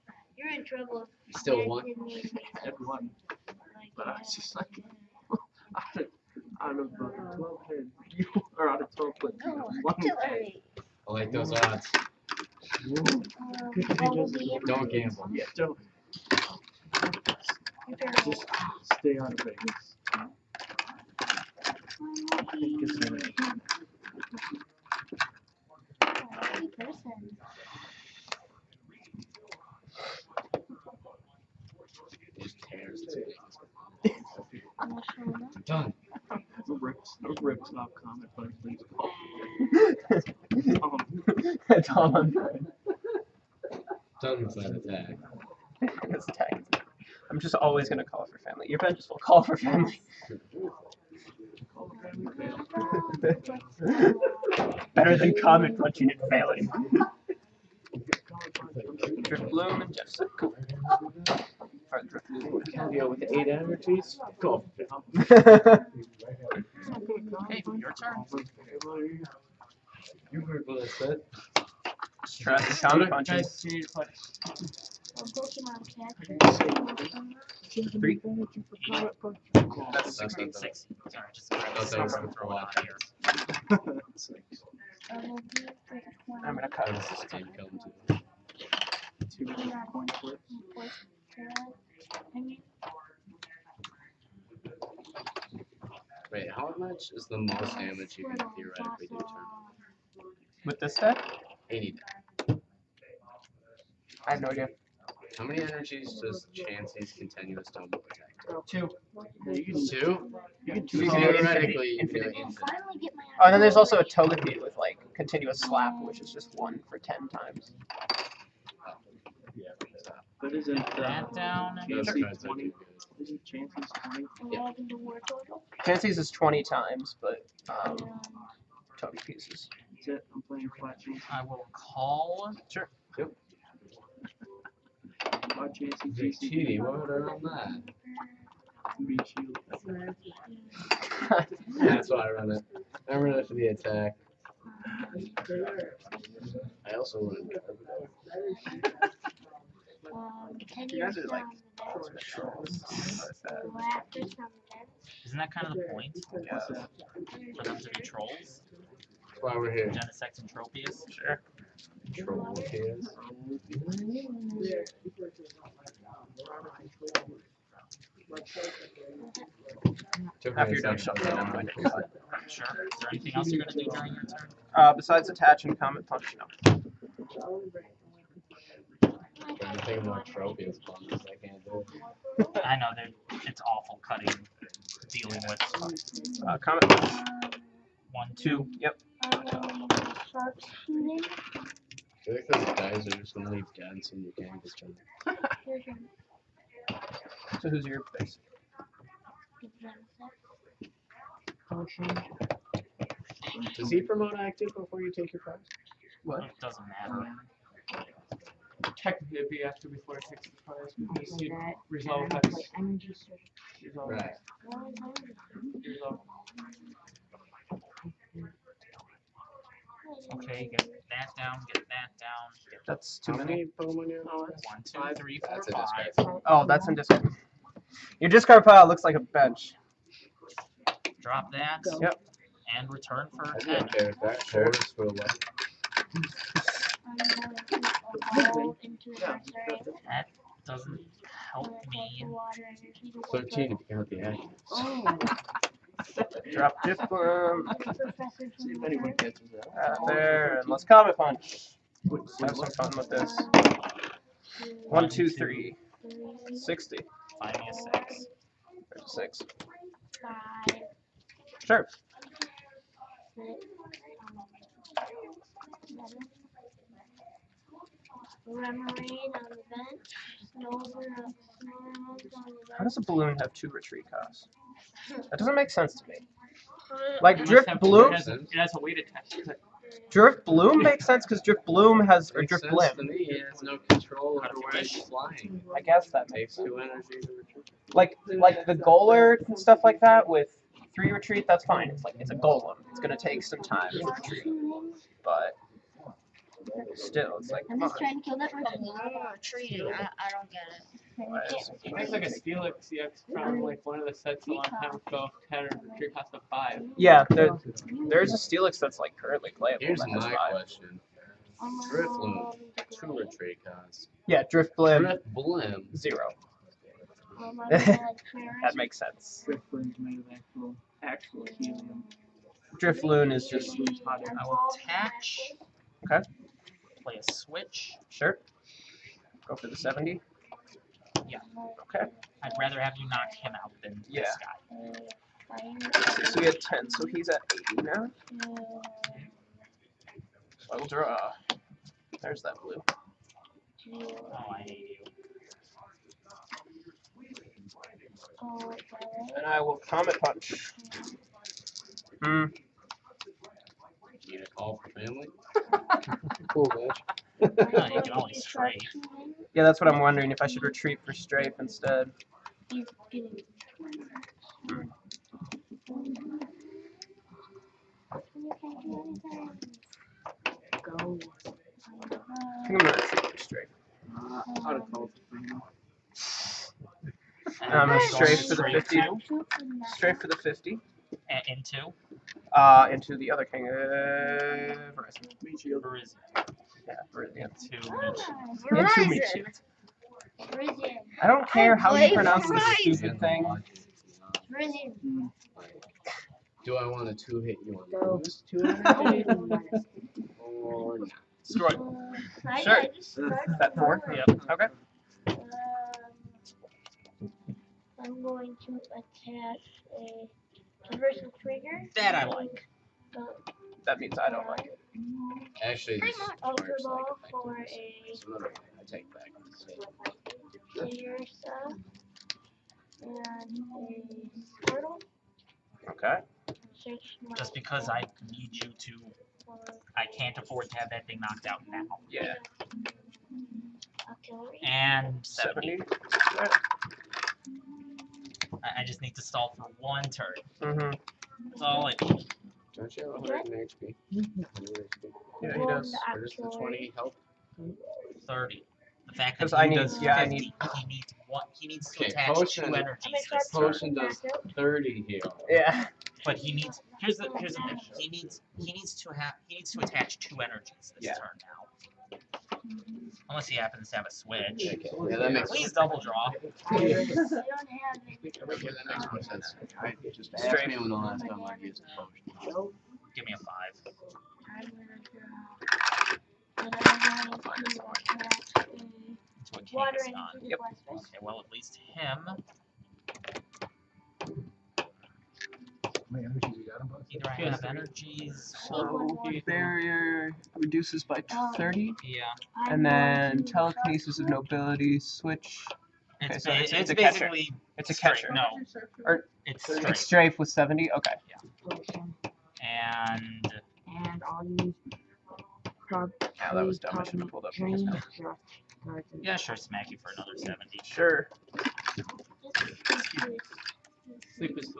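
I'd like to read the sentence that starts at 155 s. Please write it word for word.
Isn't that kind of the point?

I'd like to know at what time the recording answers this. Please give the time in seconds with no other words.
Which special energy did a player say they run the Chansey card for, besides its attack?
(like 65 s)
139 s.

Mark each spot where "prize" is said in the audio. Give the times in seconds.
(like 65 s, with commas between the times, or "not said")
205 s, 210 s.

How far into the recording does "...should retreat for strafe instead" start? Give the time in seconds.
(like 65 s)
360 s.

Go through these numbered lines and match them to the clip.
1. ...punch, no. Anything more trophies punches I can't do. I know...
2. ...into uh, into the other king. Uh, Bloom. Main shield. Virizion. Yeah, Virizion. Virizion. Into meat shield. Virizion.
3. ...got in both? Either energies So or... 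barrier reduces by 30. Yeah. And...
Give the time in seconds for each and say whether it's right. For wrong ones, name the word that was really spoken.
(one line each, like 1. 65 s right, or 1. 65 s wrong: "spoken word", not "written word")
1. 176 s right
2. 381 s wrong: "Virizion", not "Bloom"
3. 486 s right.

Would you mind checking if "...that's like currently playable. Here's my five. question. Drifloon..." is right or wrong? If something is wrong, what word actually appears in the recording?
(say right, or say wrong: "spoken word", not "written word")
right.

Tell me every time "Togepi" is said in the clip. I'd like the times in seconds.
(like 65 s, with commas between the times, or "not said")
114 s, 129 s.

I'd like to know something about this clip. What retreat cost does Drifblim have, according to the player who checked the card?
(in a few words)
Zero.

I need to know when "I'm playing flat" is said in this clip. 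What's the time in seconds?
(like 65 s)
130 s.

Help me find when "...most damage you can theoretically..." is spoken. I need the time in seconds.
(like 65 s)
97 s.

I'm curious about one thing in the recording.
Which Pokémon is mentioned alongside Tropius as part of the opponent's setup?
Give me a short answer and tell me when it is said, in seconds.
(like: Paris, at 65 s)
Genesect, at 159 s.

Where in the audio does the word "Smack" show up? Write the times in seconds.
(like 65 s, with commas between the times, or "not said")
509 s.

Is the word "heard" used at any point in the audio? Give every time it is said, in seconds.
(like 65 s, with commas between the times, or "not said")
70 s.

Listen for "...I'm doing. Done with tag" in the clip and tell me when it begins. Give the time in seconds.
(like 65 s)
42 s.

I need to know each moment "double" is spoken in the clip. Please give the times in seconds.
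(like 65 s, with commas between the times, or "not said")
107 s, 465 s.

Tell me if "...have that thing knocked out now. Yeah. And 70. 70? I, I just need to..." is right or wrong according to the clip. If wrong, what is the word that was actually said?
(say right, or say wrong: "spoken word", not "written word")
right.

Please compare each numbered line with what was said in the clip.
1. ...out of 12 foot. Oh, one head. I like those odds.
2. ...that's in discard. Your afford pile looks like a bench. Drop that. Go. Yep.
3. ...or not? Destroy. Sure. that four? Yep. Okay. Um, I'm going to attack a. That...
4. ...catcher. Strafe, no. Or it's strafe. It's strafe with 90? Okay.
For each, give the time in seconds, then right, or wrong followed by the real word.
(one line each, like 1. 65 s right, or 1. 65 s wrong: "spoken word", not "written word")
1. 8 s right
2. 226 s wrong: "discard", not "afford"
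3. 400 s right
4. 497 s wrong: "70", not "90".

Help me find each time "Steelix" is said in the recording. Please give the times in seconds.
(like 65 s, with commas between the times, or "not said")
302 s, 308 s.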